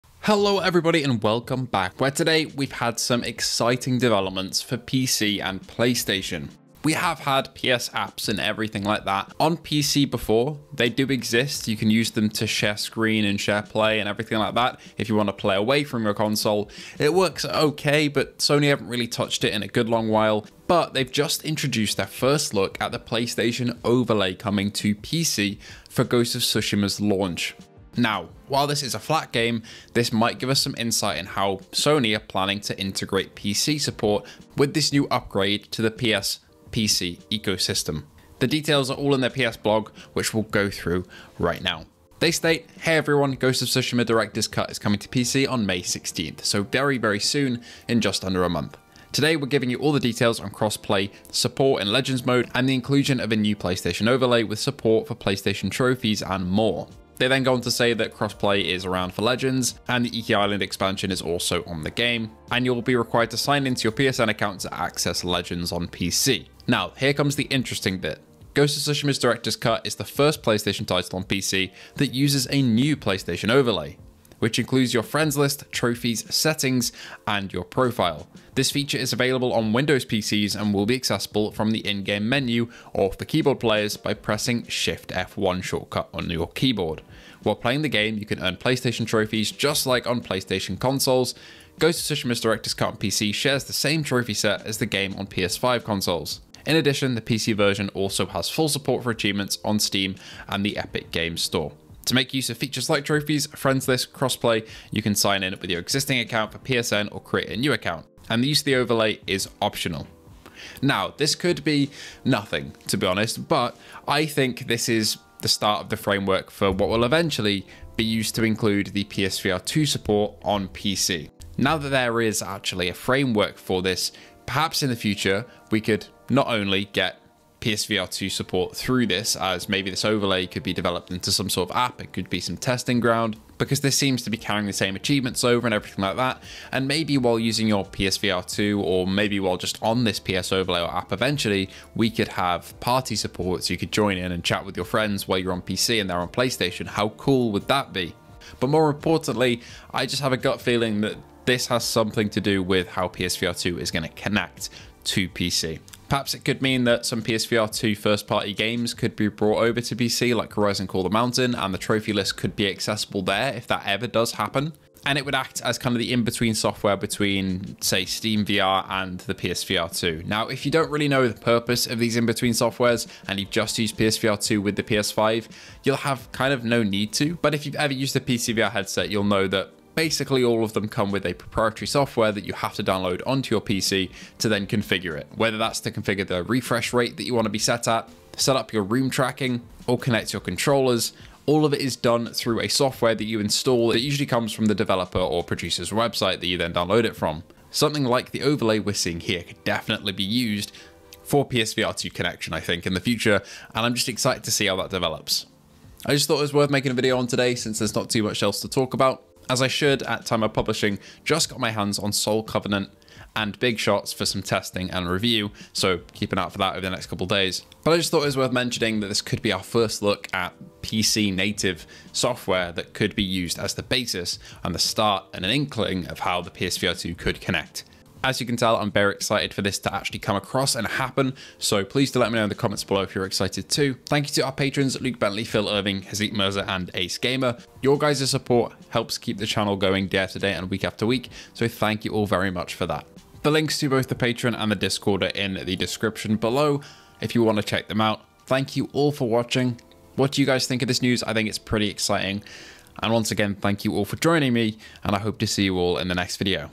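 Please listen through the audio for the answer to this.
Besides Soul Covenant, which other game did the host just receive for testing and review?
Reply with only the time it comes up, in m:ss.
3:33.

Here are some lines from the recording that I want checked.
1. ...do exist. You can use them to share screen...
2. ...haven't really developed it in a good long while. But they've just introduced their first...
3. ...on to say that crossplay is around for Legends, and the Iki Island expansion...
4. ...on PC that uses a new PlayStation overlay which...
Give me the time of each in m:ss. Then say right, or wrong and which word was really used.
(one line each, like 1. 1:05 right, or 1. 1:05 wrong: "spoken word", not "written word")
1. 0:10 right
2. 0:18 wrong: "touched", not "developed"
3. 0:57 right
4. 1:11 right.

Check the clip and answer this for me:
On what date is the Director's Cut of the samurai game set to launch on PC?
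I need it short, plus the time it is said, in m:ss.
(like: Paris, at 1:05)
May 16th, at 0:45.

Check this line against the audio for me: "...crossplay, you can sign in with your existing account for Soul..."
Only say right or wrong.
wrong.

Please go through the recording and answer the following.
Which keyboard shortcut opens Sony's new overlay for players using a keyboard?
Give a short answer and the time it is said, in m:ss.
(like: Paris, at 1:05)
Shift F1, at 1:24.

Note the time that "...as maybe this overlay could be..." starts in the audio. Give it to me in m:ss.
2:09.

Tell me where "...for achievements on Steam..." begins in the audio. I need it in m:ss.
1:39.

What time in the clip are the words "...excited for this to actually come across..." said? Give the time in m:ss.
3:49.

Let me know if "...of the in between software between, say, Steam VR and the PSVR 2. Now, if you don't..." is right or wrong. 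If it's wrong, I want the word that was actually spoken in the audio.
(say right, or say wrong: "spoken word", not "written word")
right.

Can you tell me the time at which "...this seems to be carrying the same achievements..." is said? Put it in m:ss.
2:13.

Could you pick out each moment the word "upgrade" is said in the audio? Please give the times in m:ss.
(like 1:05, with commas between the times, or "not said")
0:35.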